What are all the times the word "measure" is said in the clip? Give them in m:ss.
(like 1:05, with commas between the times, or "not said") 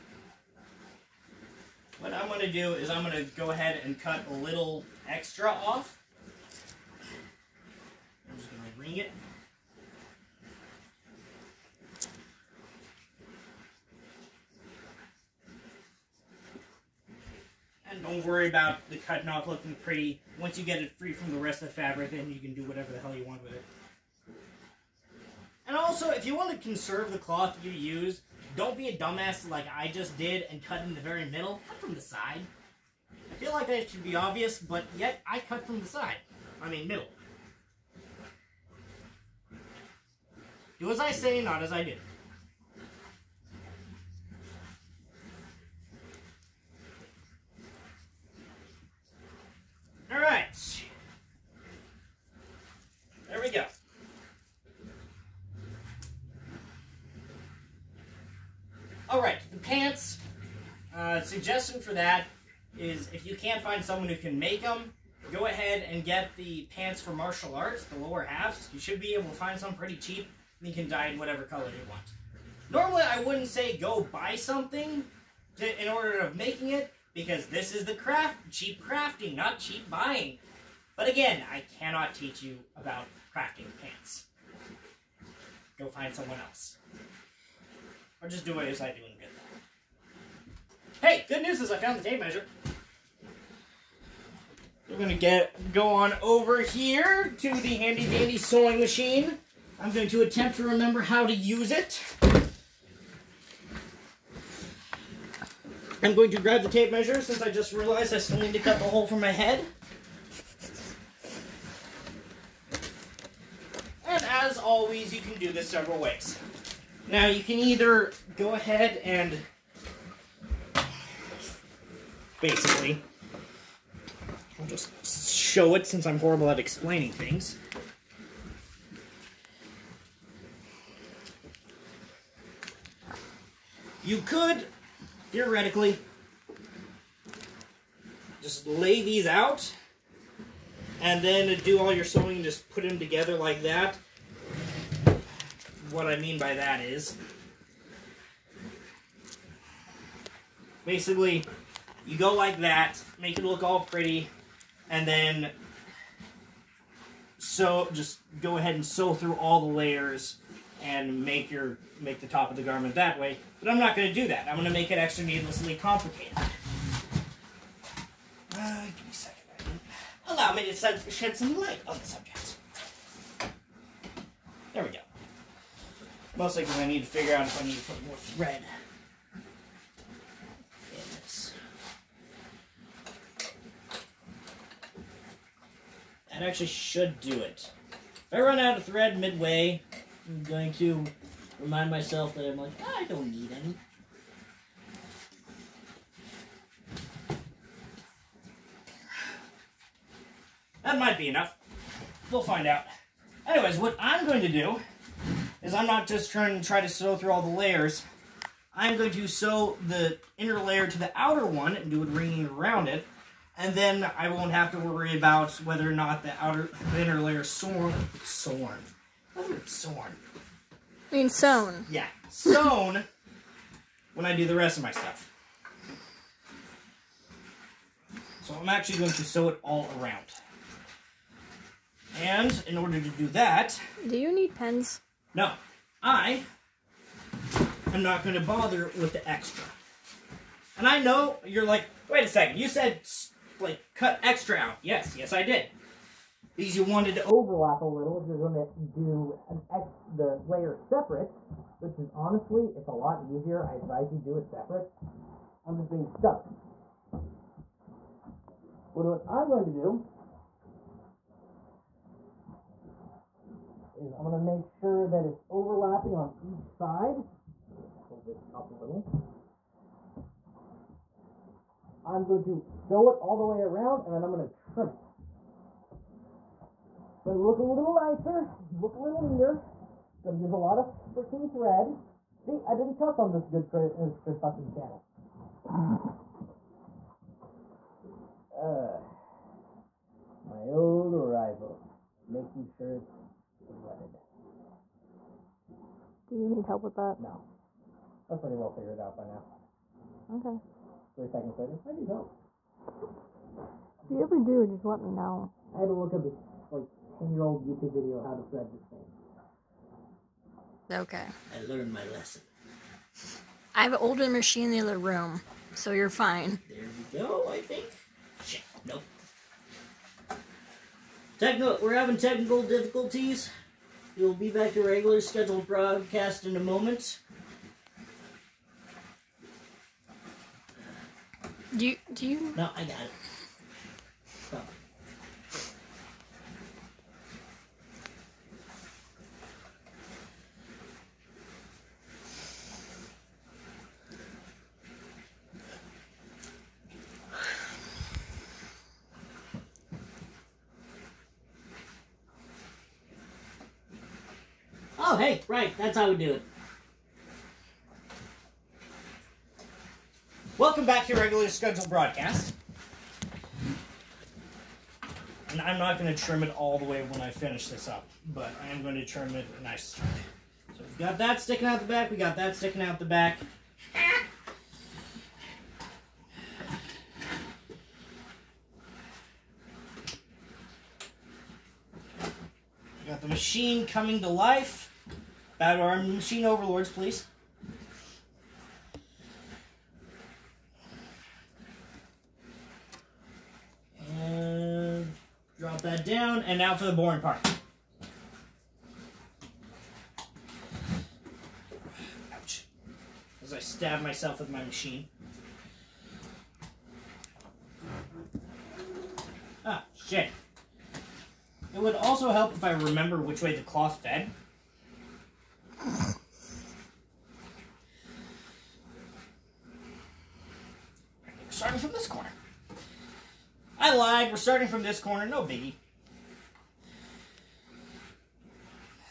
1:32, 1:46.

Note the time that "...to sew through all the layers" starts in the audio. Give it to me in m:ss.
3:26.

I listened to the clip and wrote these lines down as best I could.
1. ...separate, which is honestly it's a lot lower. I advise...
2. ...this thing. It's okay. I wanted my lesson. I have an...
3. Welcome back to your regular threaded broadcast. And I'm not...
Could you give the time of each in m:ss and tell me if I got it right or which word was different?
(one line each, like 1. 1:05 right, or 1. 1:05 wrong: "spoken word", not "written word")
1. 4:10 wrong: "easier", not "lower"
2. 5:08 wrong: "learned", not "wanted"
3. 6:00 wrong: "scheduled", not "threaded".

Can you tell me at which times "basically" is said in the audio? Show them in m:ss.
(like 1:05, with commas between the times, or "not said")
2:02, 2:30.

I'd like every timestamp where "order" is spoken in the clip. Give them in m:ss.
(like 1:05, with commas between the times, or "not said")
1:15, 3:52.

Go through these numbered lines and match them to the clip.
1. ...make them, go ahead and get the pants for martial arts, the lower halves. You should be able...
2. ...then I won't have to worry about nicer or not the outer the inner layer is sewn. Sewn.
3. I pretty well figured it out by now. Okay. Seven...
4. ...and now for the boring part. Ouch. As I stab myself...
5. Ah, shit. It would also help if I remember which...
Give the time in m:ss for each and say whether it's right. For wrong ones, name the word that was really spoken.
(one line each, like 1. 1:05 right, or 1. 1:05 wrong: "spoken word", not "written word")
1. 1:04 right
2. 3:33 wrong: "whether", not "nicer"
3. 4:58 wrong: "Three", not "Seven"
4. 6:36 right
5. 6:49 right.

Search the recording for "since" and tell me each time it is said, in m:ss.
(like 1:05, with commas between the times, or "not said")
1:47, 2:05.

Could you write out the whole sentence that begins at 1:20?
But again, I cannot teach you about crafting pants.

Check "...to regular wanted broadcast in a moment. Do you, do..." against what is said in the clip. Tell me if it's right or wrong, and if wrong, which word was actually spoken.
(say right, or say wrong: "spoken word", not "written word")
wrong: "scheduled", not "wanted".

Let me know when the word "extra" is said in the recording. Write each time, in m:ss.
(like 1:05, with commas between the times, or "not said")
0:05, 2:44, 3:59, 4:04.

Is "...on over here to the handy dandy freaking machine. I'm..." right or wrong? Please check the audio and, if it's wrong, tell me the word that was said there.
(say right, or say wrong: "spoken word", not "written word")
wrong: "sewing", not "freaking".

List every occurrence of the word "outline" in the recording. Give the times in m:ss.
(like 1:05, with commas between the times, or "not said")
not said.